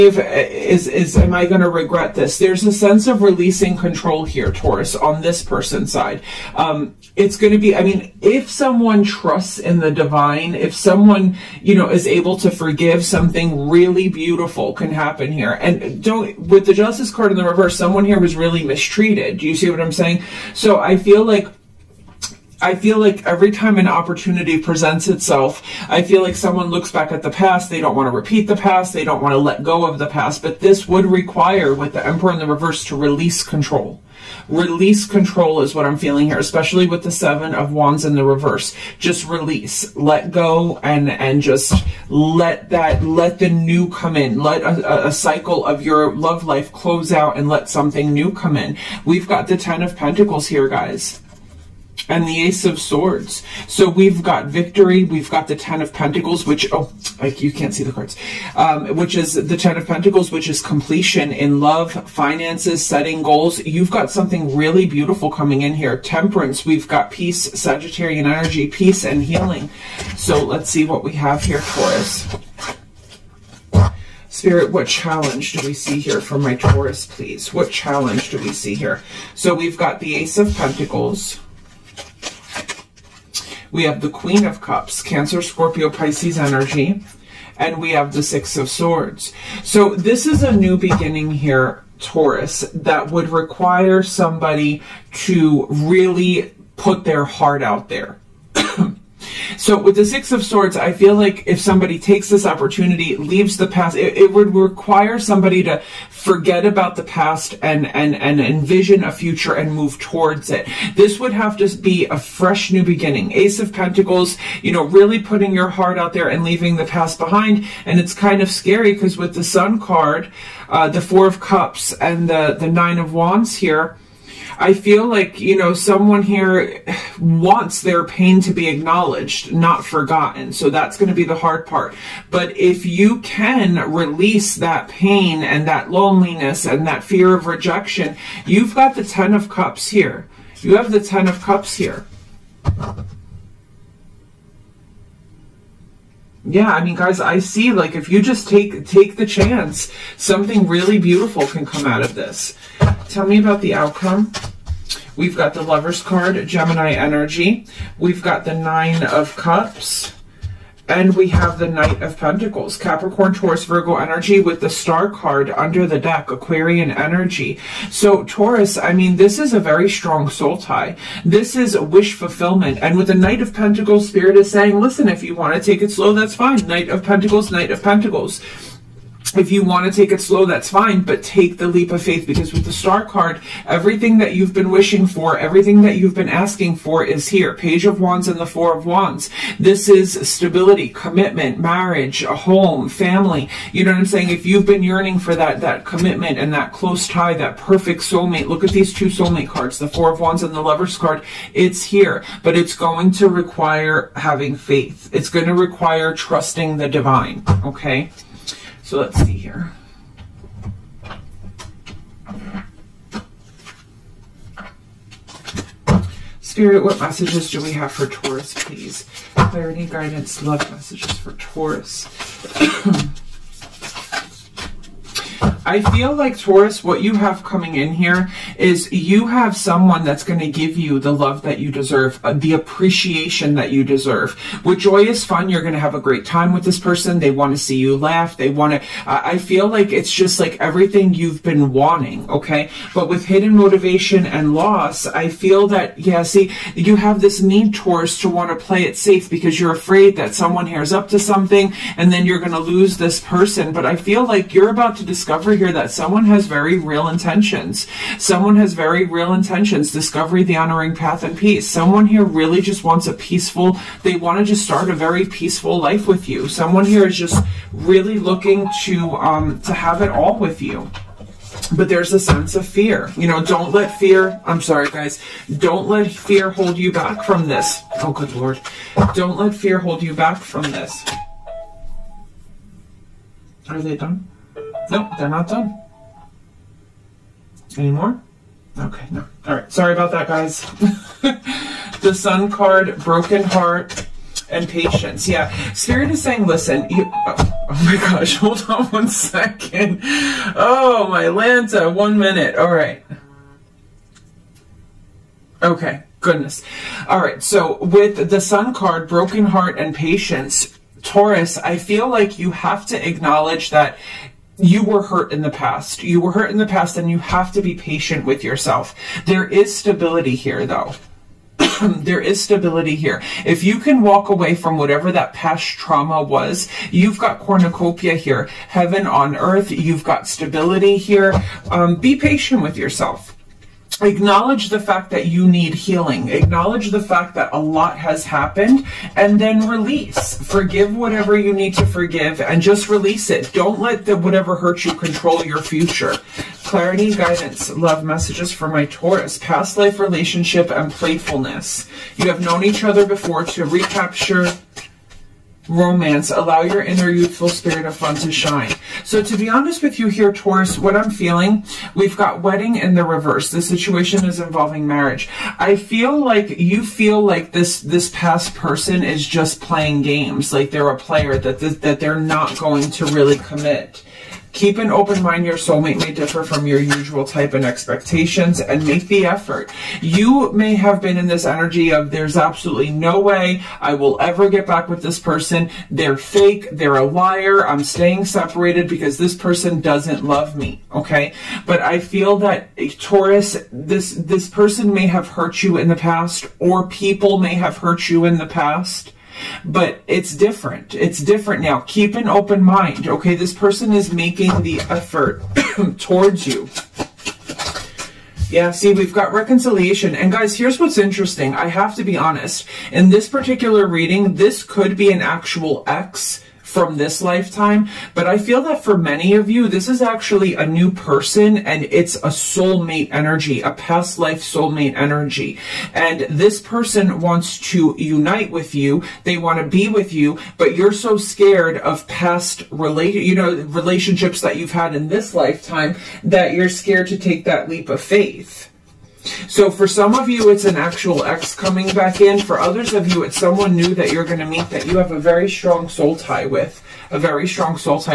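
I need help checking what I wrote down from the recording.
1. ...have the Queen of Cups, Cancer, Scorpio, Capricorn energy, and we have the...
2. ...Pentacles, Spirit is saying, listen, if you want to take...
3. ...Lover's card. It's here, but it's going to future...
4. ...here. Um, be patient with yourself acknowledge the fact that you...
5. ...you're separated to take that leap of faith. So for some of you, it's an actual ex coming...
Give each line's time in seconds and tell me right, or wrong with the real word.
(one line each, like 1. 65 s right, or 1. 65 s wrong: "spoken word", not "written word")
1. 83 s wrong: "Pisces", not "Capricorn"
2. 173 s right
3. 200 s wrong: "require", not "future"
4. 330 s right
5. 436 s wrong: "scared", not "separated".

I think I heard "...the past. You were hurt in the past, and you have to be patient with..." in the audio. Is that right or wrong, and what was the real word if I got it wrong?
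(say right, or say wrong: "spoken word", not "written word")
right.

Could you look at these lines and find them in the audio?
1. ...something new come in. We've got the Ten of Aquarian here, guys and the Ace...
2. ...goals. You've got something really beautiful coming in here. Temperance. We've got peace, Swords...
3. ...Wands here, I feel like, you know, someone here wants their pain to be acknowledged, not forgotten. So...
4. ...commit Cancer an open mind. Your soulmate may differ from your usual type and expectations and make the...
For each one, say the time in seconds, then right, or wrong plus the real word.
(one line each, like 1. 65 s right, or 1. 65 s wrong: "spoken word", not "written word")
1. 47 s wrong: "Pentacles", not "Aquarian"
2. 63 s wrong: "Sagittarian", not "Swords"
3. 123 s right
4. 373 s wrong: "Keep", not "Cancer".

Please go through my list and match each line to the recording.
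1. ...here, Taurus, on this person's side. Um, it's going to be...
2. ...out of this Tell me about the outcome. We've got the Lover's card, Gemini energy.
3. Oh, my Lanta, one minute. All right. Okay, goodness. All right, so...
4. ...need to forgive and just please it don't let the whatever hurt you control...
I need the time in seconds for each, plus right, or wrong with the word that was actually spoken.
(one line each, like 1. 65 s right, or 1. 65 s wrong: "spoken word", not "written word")
1. 4 s right
2. 151 s right
3. 300 s right
4. 341 s wrong: "release", not "please".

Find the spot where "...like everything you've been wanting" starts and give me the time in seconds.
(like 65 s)
240 s.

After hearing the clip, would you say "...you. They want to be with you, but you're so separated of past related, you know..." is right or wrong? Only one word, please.
wrong.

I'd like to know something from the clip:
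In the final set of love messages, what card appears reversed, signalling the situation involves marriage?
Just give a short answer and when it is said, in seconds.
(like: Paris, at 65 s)
Wedding, at 362 s.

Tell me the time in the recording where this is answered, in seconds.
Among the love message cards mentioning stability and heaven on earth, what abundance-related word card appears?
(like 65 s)
327 s.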